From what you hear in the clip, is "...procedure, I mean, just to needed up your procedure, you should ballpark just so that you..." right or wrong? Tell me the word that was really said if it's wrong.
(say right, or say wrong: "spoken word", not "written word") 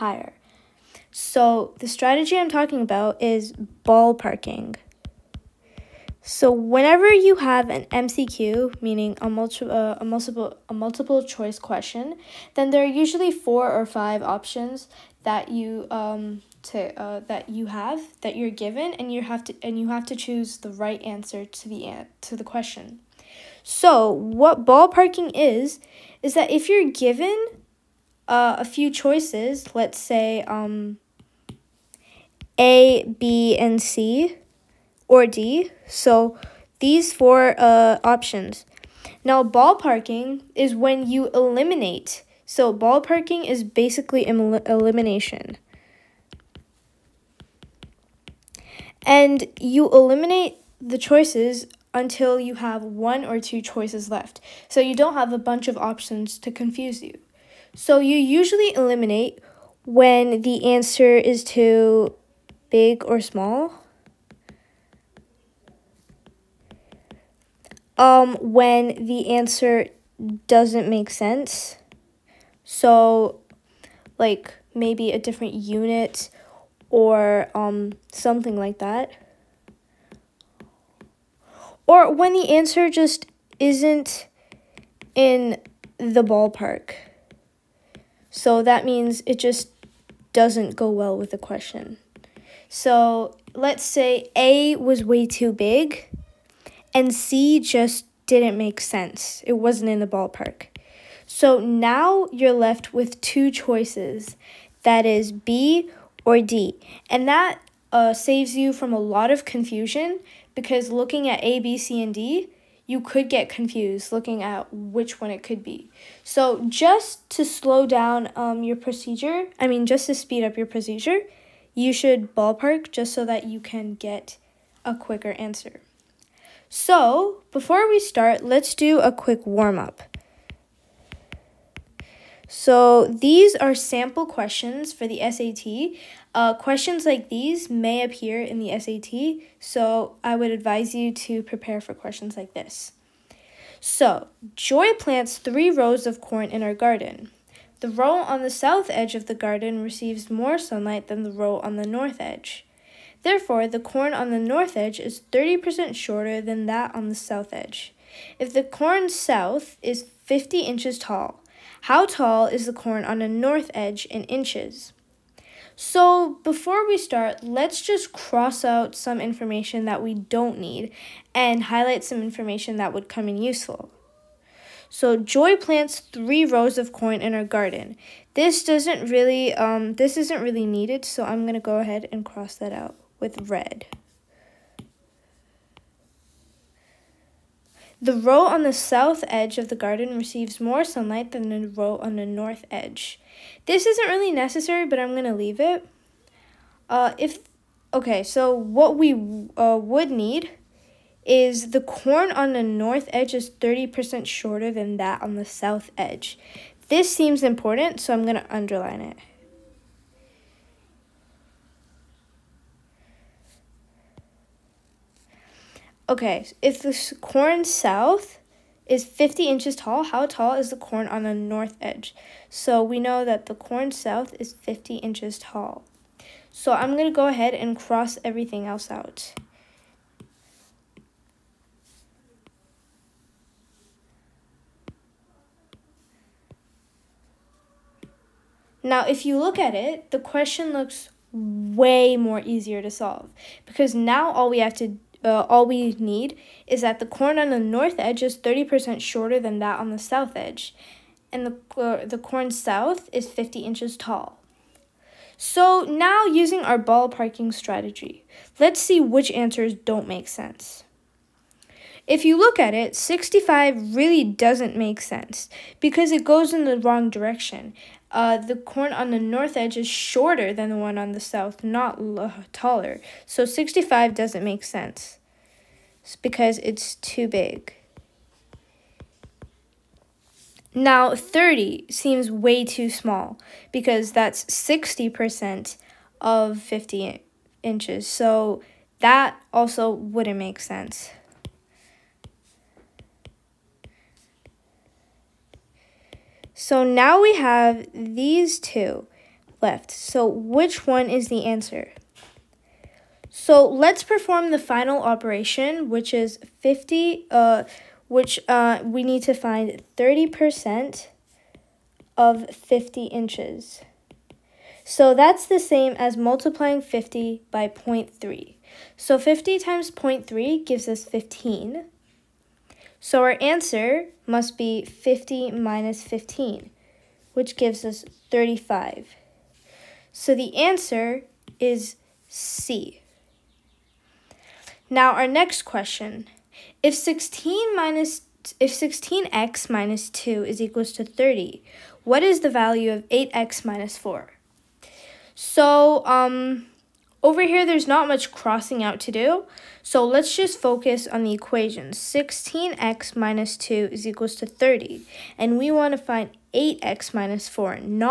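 wrong: "speed", not "needed".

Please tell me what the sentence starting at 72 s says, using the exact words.
So, like maybe a different unit or um, something like that.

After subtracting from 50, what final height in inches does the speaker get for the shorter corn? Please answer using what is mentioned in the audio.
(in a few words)
35.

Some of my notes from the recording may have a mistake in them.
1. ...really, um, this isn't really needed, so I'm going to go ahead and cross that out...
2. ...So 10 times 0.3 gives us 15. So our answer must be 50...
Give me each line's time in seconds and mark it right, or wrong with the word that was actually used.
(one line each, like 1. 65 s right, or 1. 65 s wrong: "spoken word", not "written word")
1. 179 s right
2. 318 s wrong: "50", not "10".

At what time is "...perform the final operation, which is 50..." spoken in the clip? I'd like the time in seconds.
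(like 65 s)
304 s.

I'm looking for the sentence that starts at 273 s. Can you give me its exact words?
So 65 doesn't make sense it's because it's too big.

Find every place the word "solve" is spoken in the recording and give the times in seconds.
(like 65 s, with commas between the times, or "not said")
242 s.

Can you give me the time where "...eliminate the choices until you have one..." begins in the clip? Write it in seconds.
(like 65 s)
49 s.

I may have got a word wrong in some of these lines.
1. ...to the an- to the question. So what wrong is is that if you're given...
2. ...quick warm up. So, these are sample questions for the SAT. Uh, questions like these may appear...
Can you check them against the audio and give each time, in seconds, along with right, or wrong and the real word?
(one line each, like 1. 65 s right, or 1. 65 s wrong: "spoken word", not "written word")
1. 21 s wrong: "ballparking", not "wrong"
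2. 129 s right.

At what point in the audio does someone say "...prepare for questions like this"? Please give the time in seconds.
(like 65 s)
141 s.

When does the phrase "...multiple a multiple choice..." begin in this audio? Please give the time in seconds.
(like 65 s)
10 s.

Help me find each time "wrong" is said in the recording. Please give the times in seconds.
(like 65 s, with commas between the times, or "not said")
266 s.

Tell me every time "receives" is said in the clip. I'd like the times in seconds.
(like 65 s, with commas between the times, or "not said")
149 s, 190 s.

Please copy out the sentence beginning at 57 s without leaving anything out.
So you usually eliminate when the answer is to big or small.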